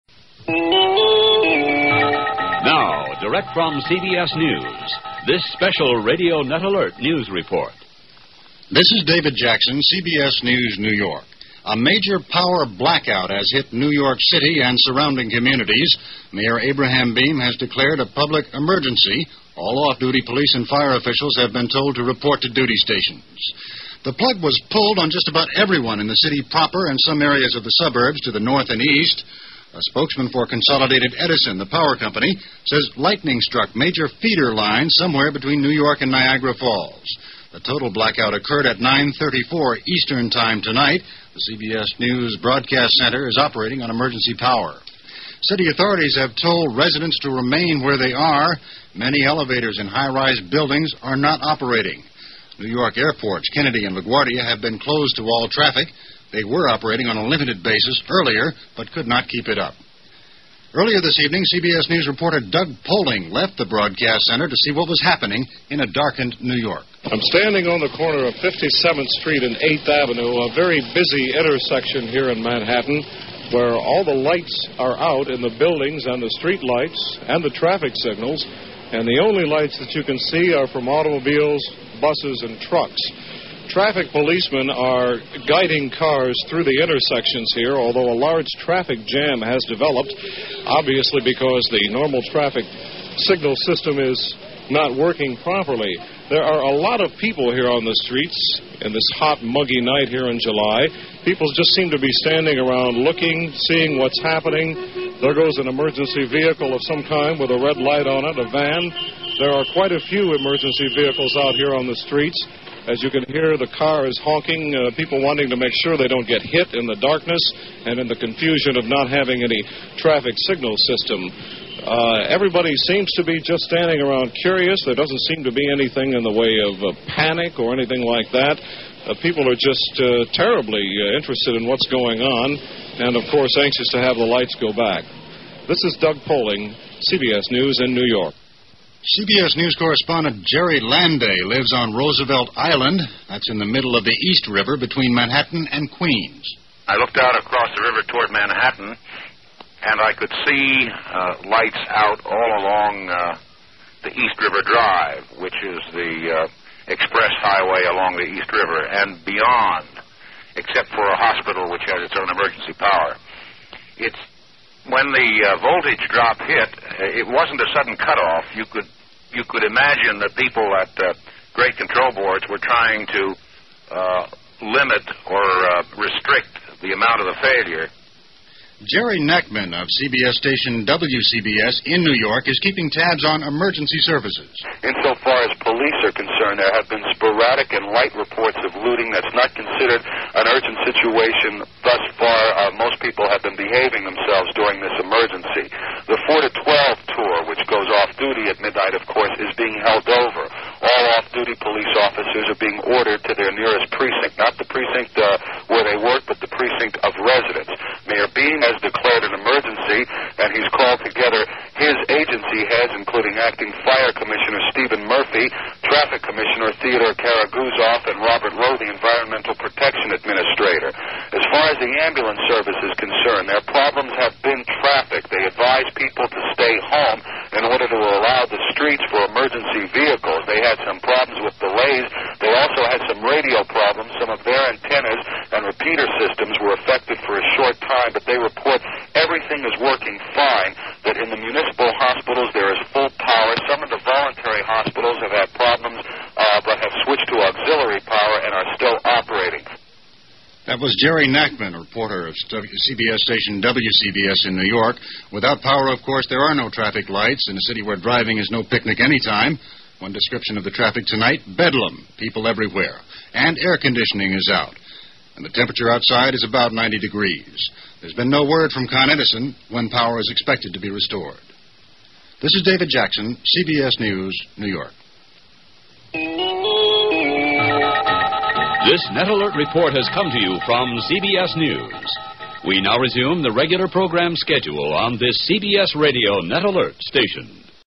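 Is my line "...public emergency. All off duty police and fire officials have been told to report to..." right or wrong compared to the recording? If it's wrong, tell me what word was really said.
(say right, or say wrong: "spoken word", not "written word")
right.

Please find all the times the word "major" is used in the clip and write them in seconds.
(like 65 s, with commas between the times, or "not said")
11 s, 33 s.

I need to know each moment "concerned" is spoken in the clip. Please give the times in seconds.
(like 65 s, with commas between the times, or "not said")
186 s, 222 s.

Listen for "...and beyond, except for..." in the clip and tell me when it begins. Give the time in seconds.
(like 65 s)
158 s.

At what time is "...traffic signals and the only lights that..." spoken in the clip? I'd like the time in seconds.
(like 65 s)
77 s.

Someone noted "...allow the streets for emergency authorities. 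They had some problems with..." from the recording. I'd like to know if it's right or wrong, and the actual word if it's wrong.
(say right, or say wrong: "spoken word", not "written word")
wrong: "vehicles", not "authorities".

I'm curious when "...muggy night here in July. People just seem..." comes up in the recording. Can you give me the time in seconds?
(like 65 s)
99 s.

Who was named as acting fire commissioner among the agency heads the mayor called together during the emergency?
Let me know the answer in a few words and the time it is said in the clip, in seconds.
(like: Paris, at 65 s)
Stephen Murphy, at 214 s.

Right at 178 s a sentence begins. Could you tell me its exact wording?
Jerry Nachman of CBS station WCBS in New York is keeping tabs on emergency services.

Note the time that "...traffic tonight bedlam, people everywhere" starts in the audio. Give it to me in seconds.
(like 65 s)
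260 s.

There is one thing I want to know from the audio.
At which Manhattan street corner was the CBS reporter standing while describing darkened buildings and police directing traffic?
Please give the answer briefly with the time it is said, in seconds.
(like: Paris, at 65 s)
57th Street and 8th Avenue, at 68 s.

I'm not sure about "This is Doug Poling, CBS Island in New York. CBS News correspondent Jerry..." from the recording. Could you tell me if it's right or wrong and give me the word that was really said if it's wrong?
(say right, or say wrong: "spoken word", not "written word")
wrong: "News", not "Island".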